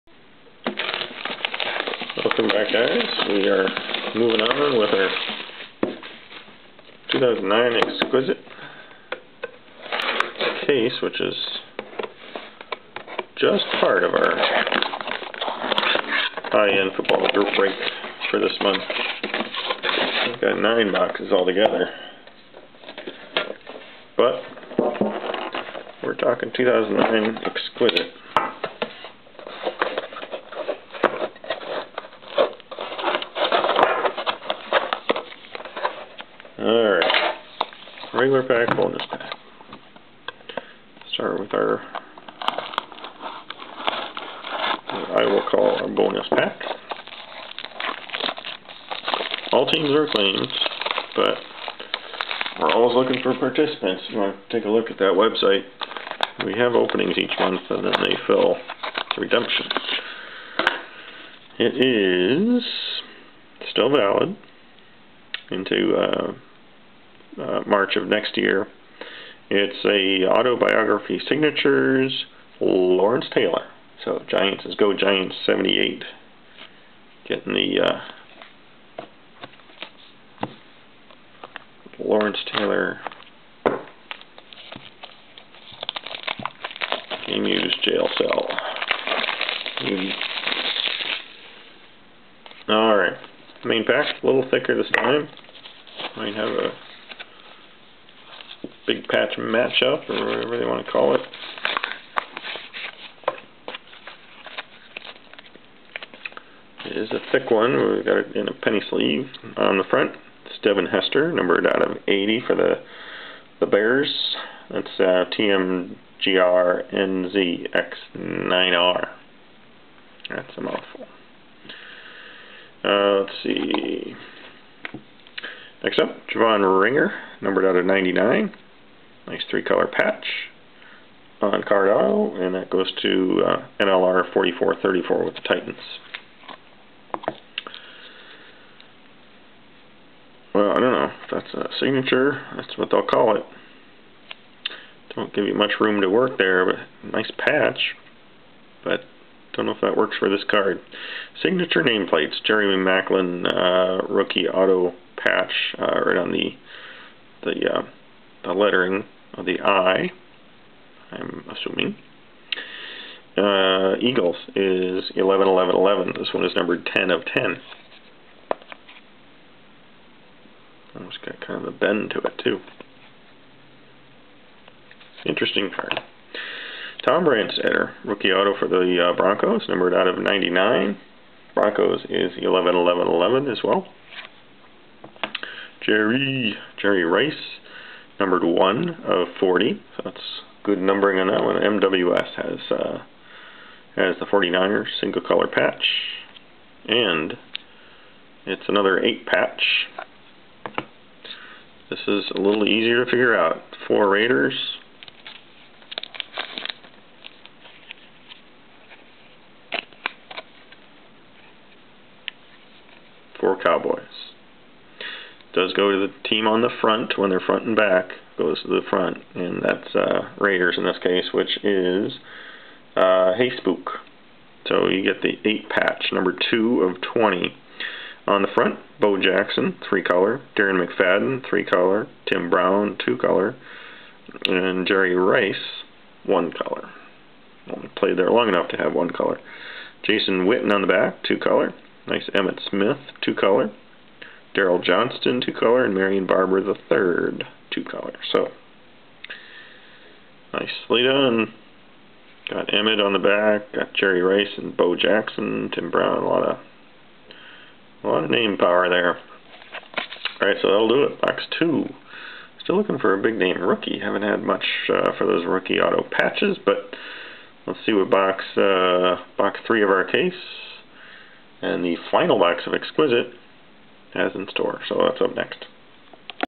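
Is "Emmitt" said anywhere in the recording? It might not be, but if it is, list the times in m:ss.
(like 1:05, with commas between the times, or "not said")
4:02, 4:12.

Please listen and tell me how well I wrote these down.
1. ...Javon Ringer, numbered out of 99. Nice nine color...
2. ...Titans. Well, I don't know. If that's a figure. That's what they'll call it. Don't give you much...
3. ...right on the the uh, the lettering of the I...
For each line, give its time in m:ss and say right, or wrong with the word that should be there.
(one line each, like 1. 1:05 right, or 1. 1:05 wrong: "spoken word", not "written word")
1. 2:06 wrong: "three", not "nine"
2. 2:15 wrong: "signature", not "figure"
3. 2:36 right.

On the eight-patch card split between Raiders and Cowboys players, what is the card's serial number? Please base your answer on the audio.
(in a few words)
2 of 20.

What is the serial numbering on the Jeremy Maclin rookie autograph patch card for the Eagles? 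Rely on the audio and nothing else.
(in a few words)
10 of 10.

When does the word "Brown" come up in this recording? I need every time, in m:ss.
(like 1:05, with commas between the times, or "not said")
3:52, 4:15.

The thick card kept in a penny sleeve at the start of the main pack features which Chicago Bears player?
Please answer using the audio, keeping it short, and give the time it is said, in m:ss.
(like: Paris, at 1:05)
Devin Hester, at 1:50.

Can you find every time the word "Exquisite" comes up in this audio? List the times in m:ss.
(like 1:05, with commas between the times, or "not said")
0:07, 0:27, 4:32.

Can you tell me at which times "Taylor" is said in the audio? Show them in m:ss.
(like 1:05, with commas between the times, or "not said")
1:13, 1:22.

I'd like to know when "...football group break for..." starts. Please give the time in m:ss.
0:16.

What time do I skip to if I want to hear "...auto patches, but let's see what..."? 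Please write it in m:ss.
4:25.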